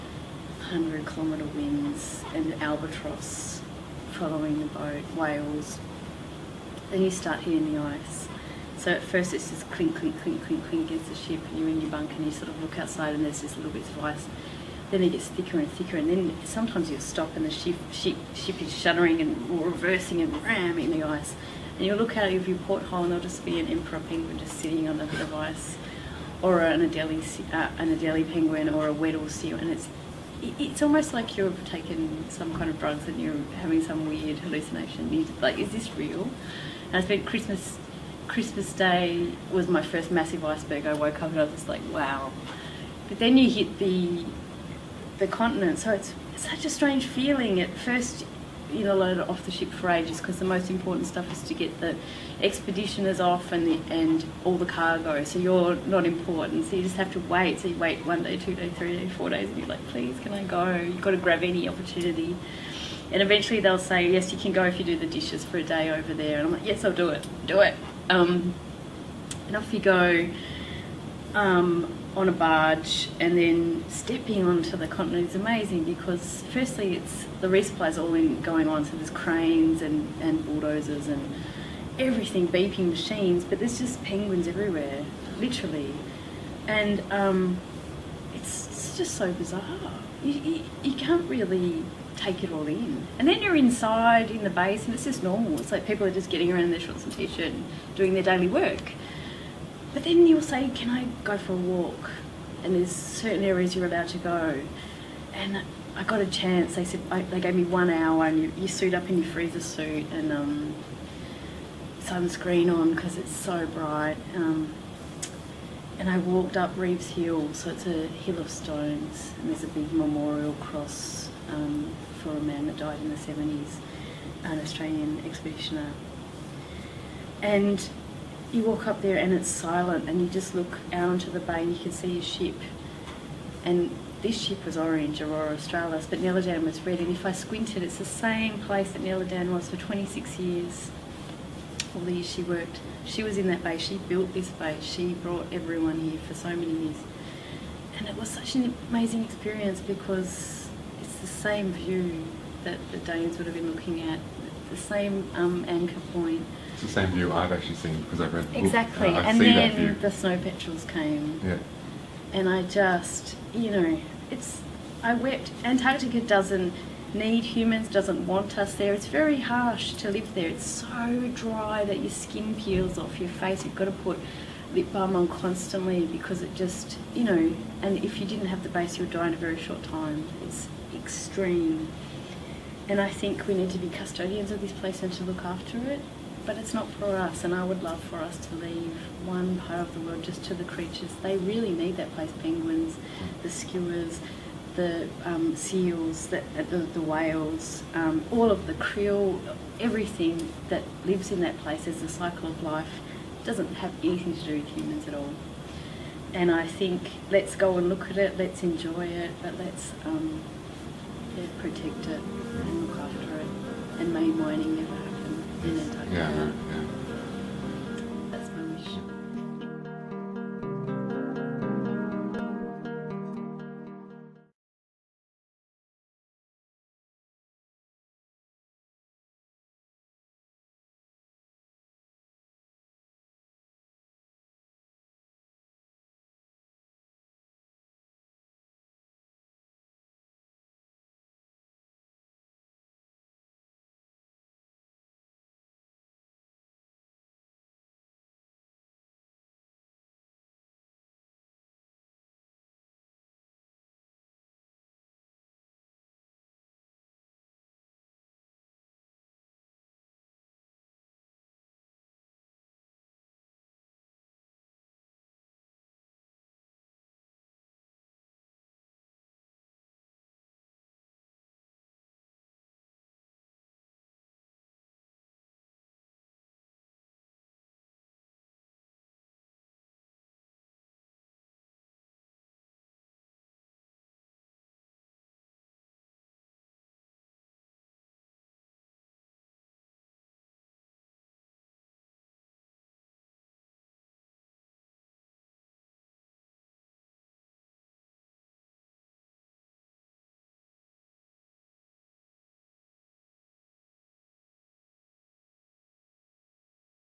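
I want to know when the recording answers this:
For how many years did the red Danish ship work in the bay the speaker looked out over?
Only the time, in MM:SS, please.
02:19.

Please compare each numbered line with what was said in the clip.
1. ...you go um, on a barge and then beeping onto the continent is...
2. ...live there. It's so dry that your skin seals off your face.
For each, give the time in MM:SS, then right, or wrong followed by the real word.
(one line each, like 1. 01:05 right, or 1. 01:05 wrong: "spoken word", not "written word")
1. 01:09 wrong: "stepping", not "beeping"
2. 02:50 wrong: "peels", not "seals".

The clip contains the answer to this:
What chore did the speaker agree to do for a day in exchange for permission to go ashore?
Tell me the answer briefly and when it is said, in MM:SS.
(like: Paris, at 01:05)
The dishes, at 01:04.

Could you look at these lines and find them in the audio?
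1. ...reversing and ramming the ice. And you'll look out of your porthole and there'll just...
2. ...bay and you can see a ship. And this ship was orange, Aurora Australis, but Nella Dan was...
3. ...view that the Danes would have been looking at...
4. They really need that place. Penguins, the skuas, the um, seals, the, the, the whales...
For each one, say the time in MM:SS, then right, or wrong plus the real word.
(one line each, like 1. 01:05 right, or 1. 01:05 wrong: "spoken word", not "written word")
1. 00:19 right
2. 02:11 right
3. 02:31 right
4. 03:11 right.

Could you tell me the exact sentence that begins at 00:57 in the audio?
So you wait one day, two days, three days, four days, and you're like, please, can I go?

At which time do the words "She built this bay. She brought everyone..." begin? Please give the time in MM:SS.
02:23.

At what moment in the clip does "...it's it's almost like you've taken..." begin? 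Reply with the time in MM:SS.
00:29.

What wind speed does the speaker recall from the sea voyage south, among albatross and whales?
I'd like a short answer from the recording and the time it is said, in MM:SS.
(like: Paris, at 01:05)
100 kilometres, at 00:00.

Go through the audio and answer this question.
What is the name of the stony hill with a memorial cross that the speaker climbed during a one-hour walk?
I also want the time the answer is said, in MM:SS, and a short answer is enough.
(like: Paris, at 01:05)
Reeves Hill, at 01:56.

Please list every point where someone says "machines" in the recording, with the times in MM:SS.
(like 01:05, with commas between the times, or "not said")
01:22.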